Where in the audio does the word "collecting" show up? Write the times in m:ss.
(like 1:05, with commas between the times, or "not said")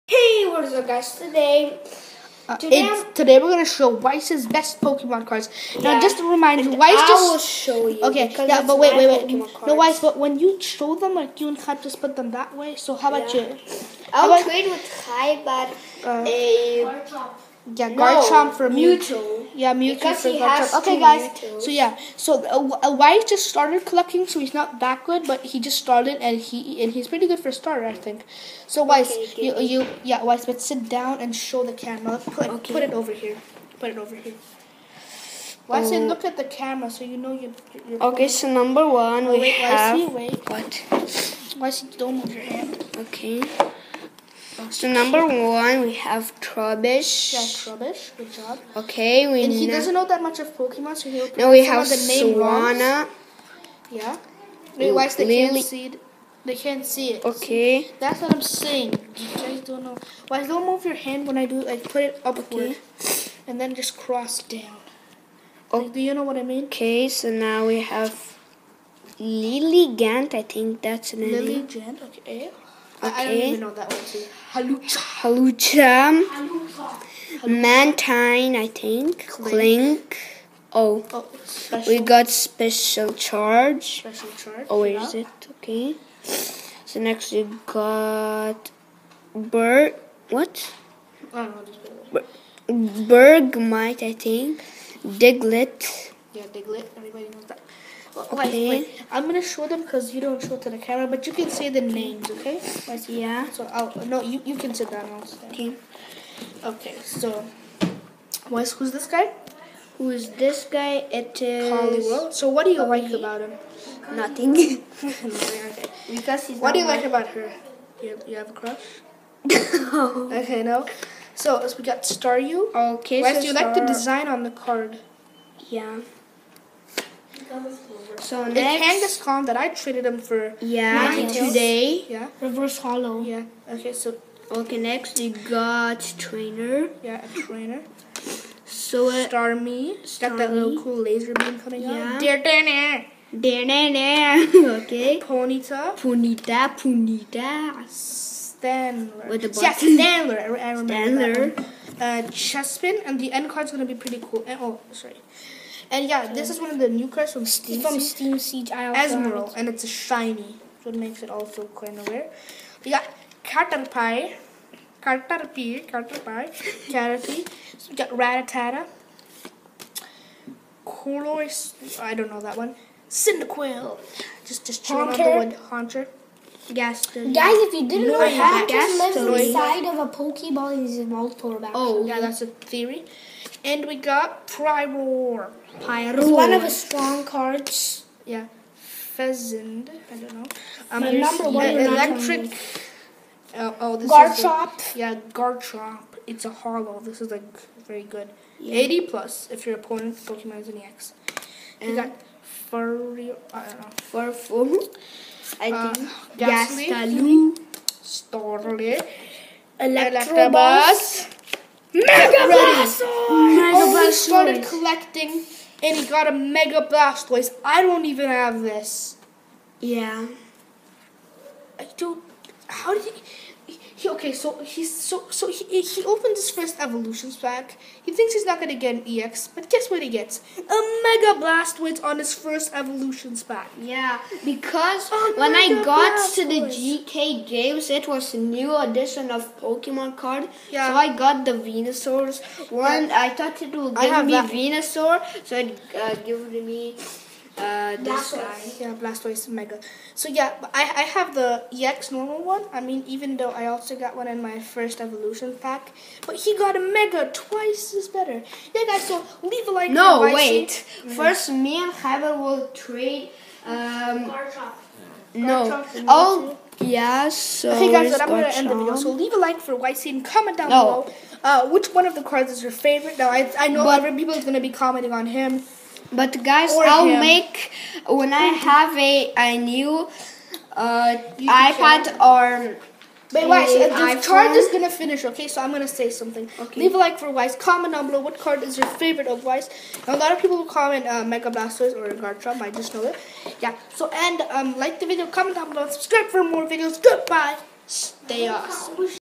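0:23, 3:34.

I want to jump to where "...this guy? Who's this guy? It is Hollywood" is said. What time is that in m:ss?
1:48.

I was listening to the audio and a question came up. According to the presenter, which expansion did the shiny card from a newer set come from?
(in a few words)
Steam Siege.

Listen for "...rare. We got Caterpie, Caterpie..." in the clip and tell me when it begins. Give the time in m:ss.
2:42.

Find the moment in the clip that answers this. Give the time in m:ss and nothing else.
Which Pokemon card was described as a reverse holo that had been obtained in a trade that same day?
2:08.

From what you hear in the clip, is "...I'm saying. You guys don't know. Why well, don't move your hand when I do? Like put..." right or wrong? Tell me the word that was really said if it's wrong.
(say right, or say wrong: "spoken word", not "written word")
right.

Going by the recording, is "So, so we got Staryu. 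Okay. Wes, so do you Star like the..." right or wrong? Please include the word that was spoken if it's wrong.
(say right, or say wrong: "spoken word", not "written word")
right.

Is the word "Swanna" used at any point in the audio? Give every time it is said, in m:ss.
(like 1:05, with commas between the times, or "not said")
0:52.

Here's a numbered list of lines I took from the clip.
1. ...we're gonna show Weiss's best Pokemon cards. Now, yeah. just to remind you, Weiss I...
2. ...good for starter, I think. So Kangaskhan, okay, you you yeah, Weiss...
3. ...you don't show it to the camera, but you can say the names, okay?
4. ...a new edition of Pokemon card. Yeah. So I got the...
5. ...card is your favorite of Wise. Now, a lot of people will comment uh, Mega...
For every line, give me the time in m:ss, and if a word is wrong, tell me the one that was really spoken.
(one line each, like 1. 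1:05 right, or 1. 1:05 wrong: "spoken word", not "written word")
1. 0:03 right
2. 0:27 wrong: "Weiss", not "Kangaskhan"
3. 1:40 right
4. 3:58 right
5. 4:48 right.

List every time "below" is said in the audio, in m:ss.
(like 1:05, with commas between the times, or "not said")
4:31, 4:48, 4:55.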